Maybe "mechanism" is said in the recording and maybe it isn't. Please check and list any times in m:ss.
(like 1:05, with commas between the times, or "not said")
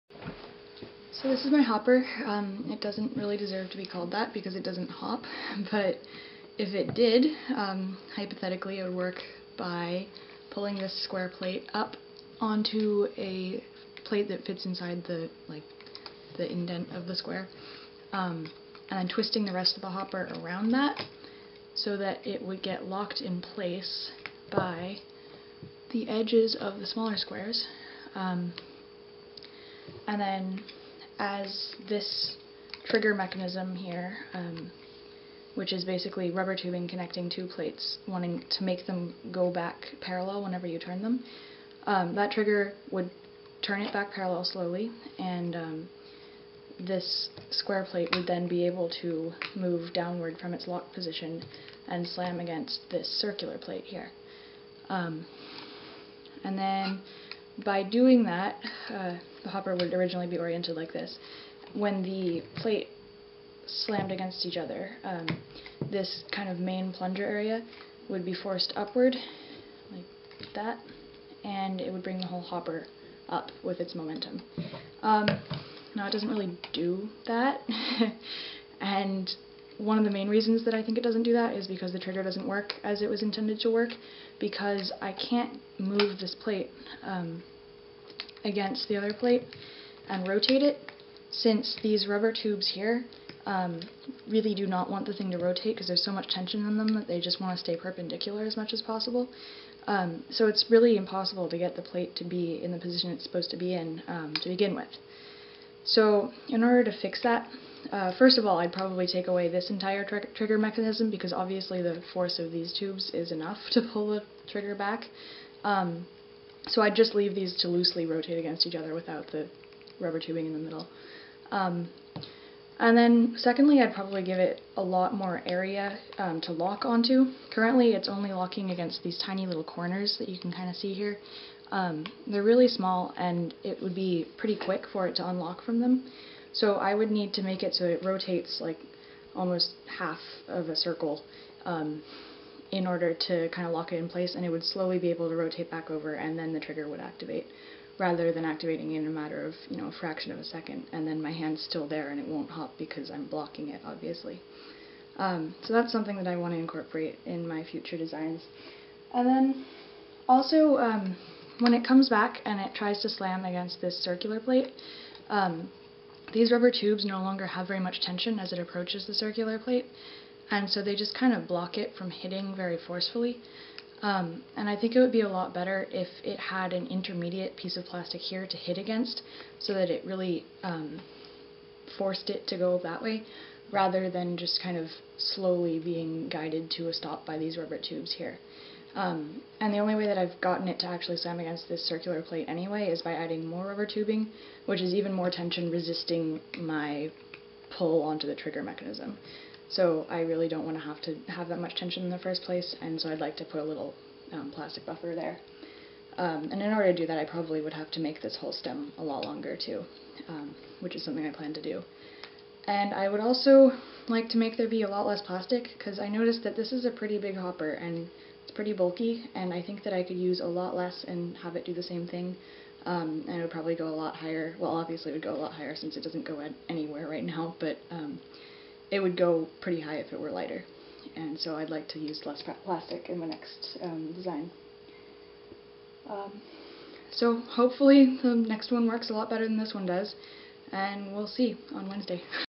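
0:33, 1:50, 3:18.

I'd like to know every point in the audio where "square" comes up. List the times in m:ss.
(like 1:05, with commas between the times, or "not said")
0:11, 0:17, 0:27, 0:47.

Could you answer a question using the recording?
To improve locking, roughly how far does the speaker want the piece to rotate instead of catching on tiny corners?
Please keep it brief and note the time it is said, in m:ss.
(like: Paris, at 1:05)
almost half of a circle, at 2:19.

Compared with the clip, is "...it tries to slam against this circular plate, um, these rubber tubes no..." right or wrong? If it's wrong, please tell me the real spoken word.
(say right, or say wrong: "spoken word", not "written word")
right.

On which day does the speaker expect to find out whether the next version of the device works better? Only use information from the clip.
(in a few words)
Wednesday.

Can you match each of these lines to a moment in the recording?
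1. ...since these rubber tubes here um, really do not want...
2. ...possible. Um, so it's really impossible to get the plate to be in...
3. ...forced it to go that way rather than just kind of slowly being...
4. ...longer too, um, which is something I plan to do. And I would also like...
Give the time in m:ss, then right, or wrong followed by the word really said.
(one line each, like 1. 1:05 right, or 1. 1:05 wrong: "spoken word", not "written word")
1. 1:31 right
2. 1:38 right
3. 3:01 right
4. 3:29 right.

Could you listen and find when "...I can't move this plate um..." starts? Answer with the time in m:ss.
1:25.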